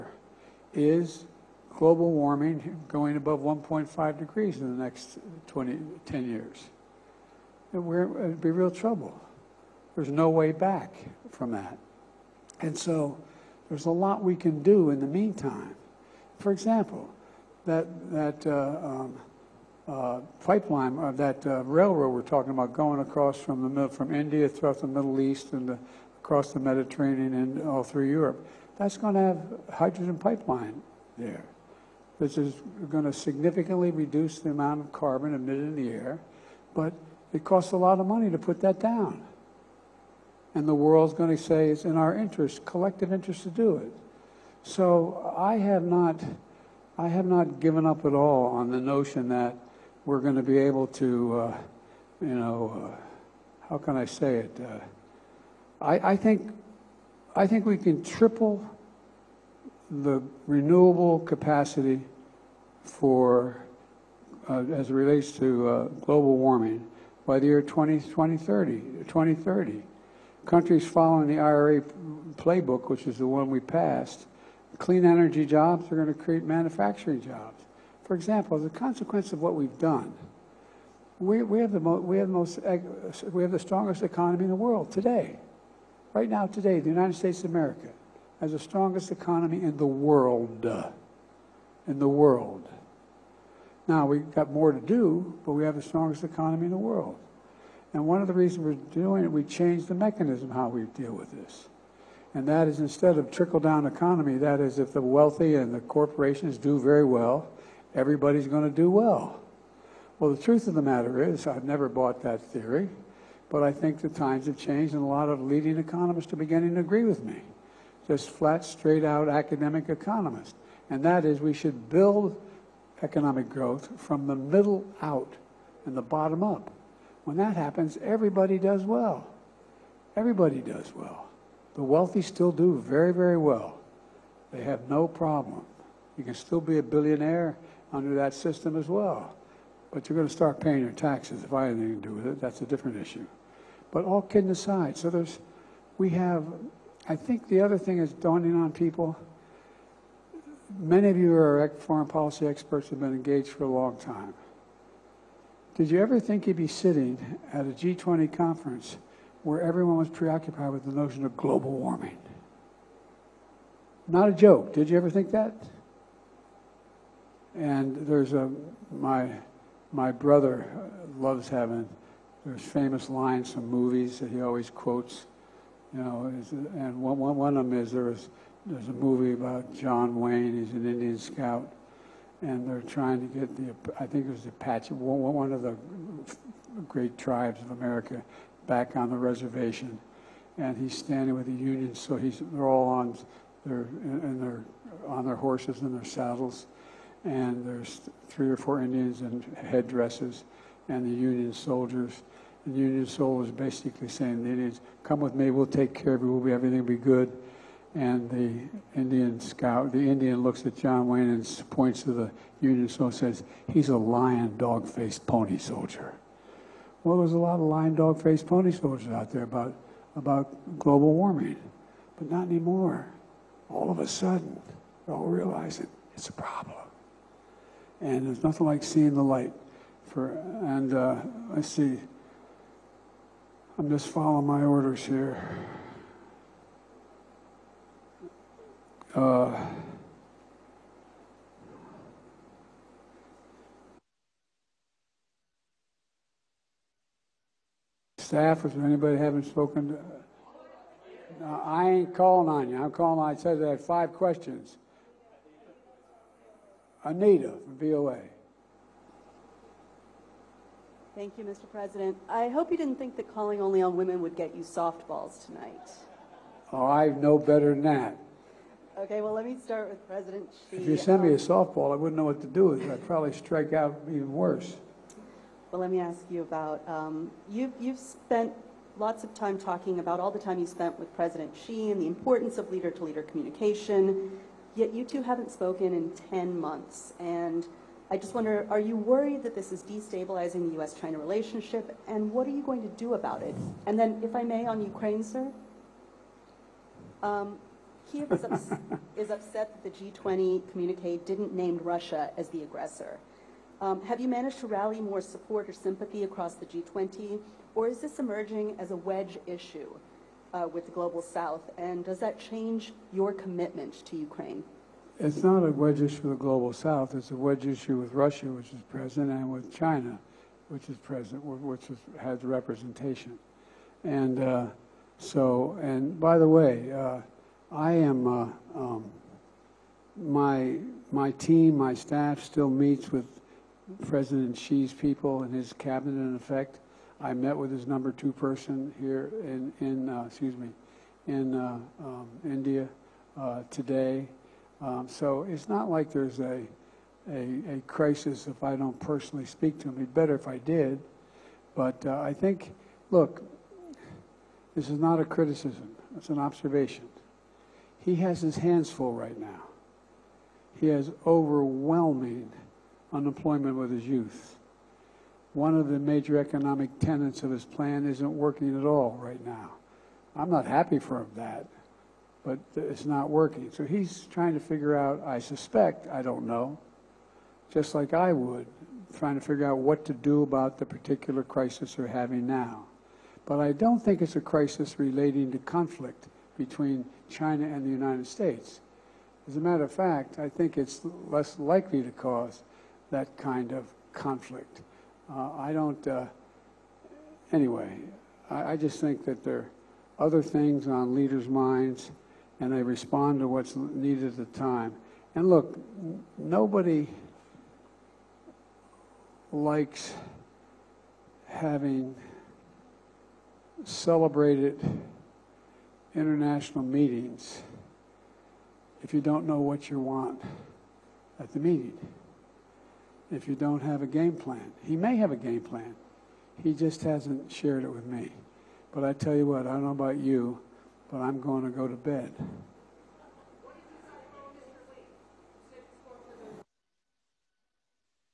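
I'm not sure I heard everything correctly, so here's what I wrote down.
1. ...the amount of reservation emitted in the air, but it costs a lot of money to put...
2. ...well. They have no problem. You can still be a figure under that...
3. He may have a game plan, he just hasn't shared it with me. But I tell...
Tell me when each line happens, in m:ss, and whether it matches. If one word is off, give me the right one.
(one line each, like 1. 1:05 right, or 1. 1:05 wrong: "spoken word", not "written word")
1. 0:34 wrong: "carbon", not "reservation"
2. 2:13 wrong: "billionaire", not "figure"
3. 7:04 right.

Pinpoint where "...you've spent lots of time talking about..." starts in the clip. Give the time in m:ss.
4:37.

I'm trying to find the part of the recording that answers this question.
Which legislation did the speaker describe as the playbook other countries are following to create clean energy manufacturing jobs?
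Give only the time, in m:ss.
1:11.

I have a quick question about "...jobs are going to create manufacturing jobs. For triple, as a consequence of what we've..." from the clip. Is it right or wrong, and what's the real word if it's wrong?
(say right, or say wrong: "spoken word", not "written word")
wrong: "example", not "triple".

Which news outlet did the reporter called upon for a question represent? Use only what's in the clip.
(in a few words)
VOA.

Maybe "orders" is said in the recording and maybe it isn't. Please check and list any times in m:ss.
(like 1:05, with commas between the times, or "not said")
3:54.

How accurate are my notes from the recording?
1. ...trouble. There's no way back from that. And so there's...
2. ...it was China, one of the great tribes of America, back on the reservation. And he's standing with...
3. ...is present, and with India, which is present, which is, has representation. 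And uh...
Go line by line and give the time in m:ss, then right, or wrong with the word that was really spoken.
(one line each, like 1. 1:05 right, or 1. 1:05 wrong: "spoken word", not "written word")
1. 0:08 right
2. 3:04 wrong: "Apache", not "China"
3. 5:18 wrong: "China", not "India".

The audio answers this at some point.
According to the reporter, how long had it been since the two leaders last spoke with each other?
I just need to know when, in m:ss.
4:46.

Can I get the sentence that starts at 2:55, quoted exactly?
You know, and one, one, one of them is there was, there's a movie about John Wayne.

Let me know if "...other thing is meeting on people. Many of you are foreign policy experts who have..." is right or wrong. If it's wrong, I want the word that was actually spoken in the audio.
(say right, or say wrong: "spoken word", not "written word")
wrong: "dawning", not "meeting".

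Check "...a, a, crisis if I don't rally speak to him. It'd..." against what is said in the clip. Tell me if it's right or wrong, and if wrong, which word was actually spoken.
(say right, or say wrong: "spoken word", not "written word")
wrong: "personally", not "rally".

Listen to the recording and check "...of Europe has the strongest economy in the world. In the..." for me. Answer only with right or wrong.
wrong.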